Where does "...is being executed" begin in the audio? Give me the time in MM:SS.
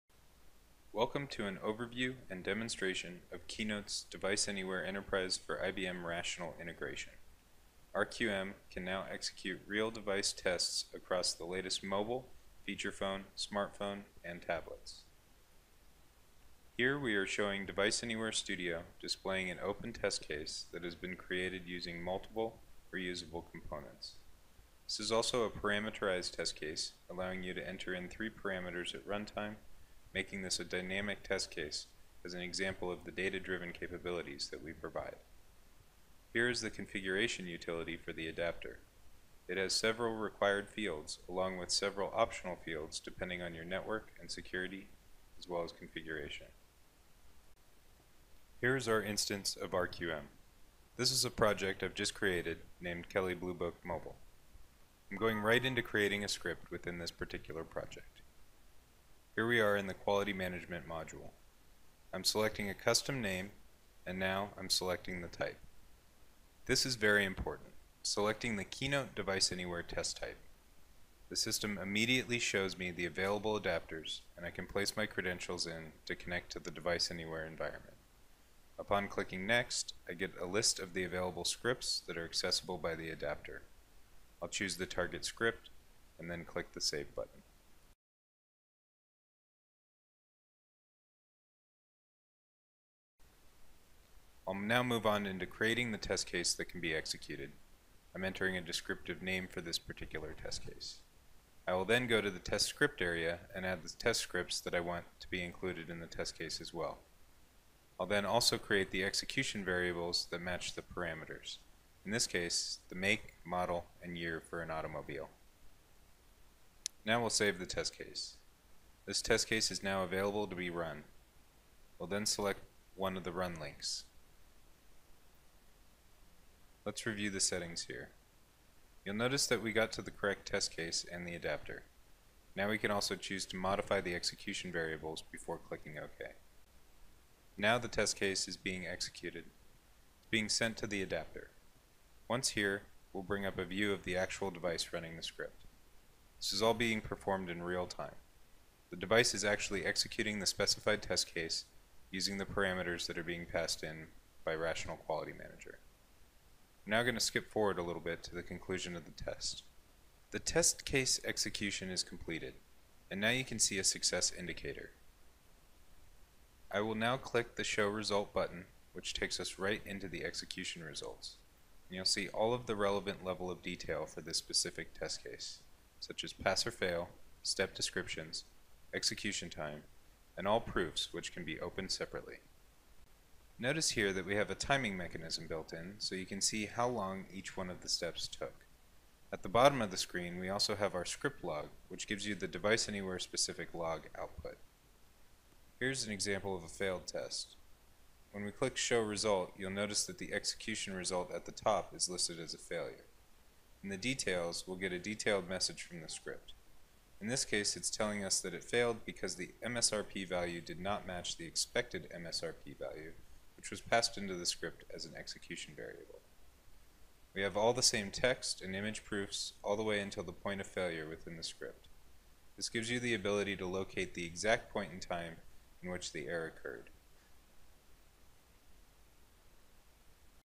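02:18.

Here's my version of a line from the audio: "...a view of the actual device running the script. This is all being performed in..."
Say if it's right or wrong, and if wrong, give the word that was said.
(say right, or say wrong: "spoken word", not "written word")
right.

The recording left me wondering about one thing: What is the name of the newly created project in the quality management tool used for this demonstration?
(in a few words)
Kelley Blue Book Mobile.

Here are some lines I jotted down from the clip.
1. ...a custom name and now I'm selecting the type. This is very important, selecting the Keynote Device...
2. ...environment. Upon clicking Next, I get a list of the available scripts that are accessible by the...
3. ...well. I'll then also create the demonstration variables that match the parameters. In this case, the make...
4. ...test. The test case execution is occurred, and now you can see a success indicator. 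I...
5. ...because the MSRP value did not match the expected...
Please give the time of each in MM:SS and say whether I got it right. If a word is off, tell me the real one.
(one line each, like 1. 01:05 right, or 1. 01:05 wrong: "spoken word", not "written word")
1. 01:02 right
2. 01:17 right
3. 01:46 wrong: "execution", not "demonstration"
4. 02:39 wrong: "completed", not "occurred"
5. 03:29 right.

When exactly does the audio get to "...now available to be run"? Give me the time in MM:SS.
01:59.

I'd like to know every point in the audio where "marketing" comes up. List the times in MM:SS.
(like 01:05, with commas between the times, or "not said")
not said.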